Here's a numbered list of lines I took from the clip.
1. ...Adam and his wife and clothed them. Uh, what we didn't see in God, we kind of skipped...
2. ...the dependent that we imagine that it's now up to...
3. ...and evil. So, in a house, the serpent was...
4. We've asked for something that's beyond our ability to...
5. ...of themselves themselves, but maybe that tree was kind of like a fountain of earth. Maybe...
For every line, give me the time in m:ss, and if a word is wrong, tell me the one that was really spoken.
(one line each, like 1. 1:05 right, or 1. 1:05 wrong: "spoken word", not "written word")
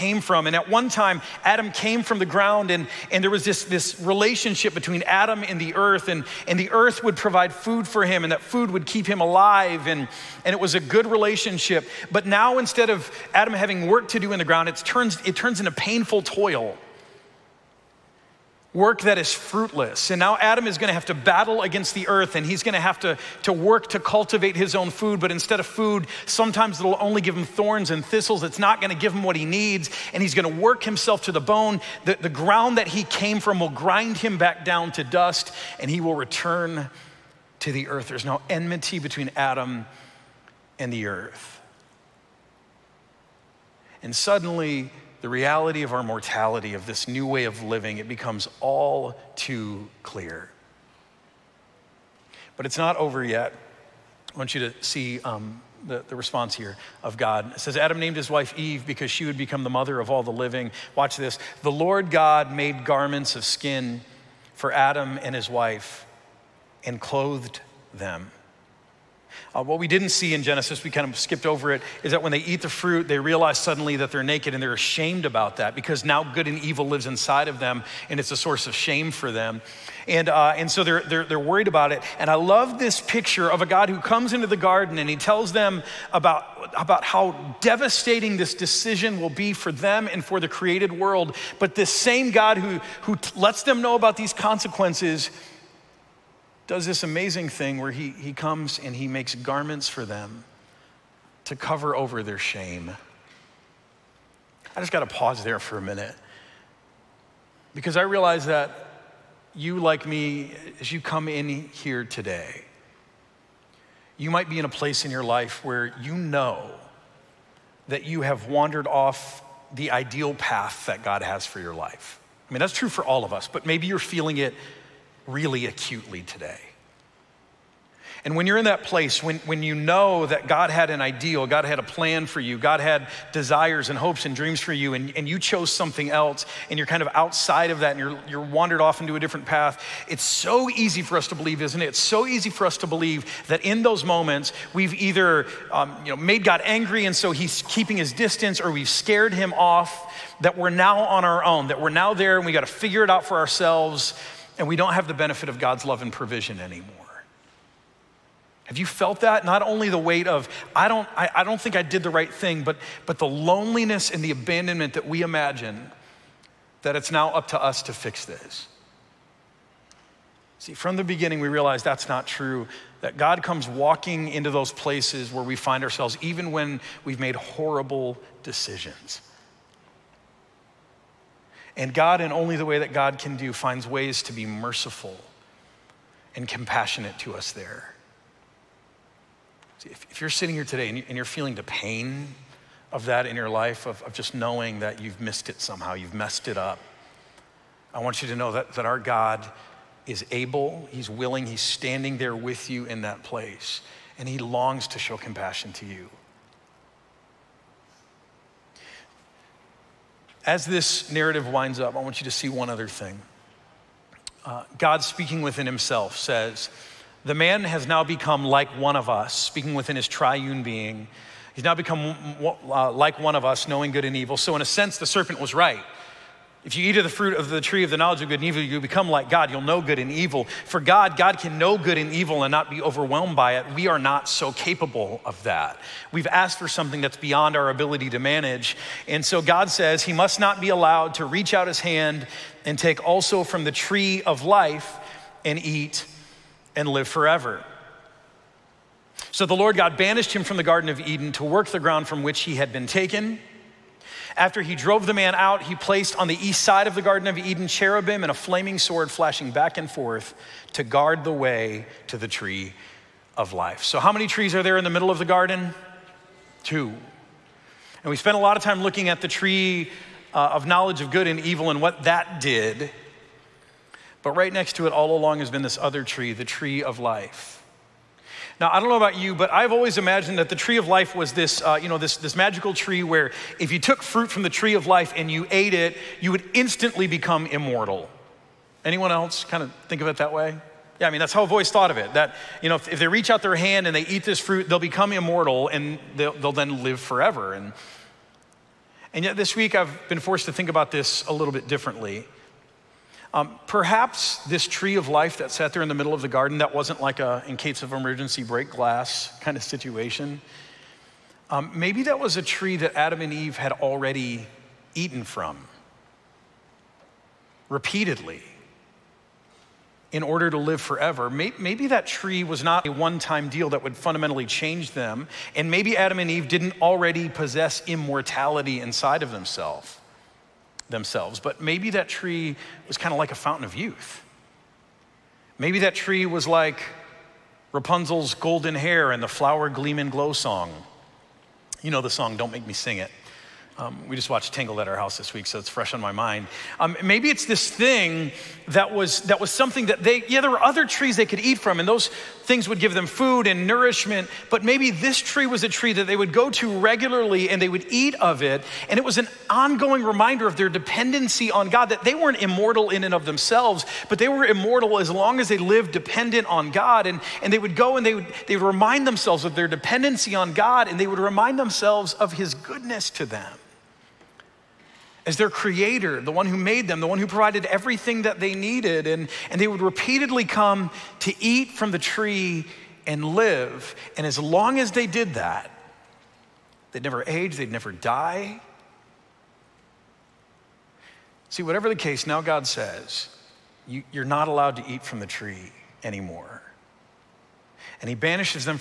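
1. 1:04 wrong: "Genesis", not "God"
2. 2:44 wrong: "abandonment", not "dependent"
3. 3:44 wrong: "sense", not "house"
4. 3:56 right
5. 5:29 wrong: "youth", not "earth".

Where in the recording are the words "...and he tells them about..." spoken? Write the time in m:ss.
1:24.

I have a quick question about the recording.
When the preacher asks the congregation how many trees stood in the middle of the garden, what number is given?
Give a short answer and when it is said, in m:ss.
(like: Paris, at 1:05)
2, at 4:26.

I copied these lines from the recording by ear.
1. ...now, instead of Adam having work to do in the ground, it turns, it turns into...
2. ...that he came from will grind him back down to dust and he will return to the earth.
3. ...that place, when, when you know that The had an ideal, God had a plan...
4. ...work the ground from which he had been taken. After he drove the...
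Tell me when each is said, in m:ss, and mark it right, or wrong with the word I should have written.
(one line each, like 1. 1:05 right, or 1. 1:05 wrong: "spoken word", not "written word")
1. 0:12 right
2. 0:32 right
3. 2:08 wrong: "God", not "The"
4. 4:11 right.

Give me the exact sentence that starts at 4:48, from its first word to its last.
Anyone else kind of think of it that way?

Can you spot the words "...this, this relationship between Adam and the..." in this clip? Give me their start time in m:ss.
0:03.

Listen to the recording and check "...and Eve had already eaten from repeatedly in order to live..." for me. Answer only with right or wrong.
right.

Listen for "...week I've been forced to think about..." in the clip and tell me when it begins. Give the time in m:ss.
4:59.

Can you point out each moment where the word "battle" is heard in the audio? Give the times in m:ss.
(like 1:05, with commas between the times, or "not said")
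0:21.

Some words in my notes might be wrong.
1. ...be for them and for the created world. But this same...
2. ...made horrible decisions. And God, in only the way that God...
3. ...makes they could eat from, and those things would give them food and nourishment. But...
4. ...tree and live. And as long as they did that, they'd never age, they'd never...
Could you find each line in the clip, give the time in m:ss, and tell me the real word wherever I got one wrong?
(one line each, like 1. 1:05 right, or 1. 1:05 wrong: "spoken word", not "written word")
1. 1:29 right
2. 2:57 right
3. 5:50 wrong: "trees", not "makes"
4. 6:21 right.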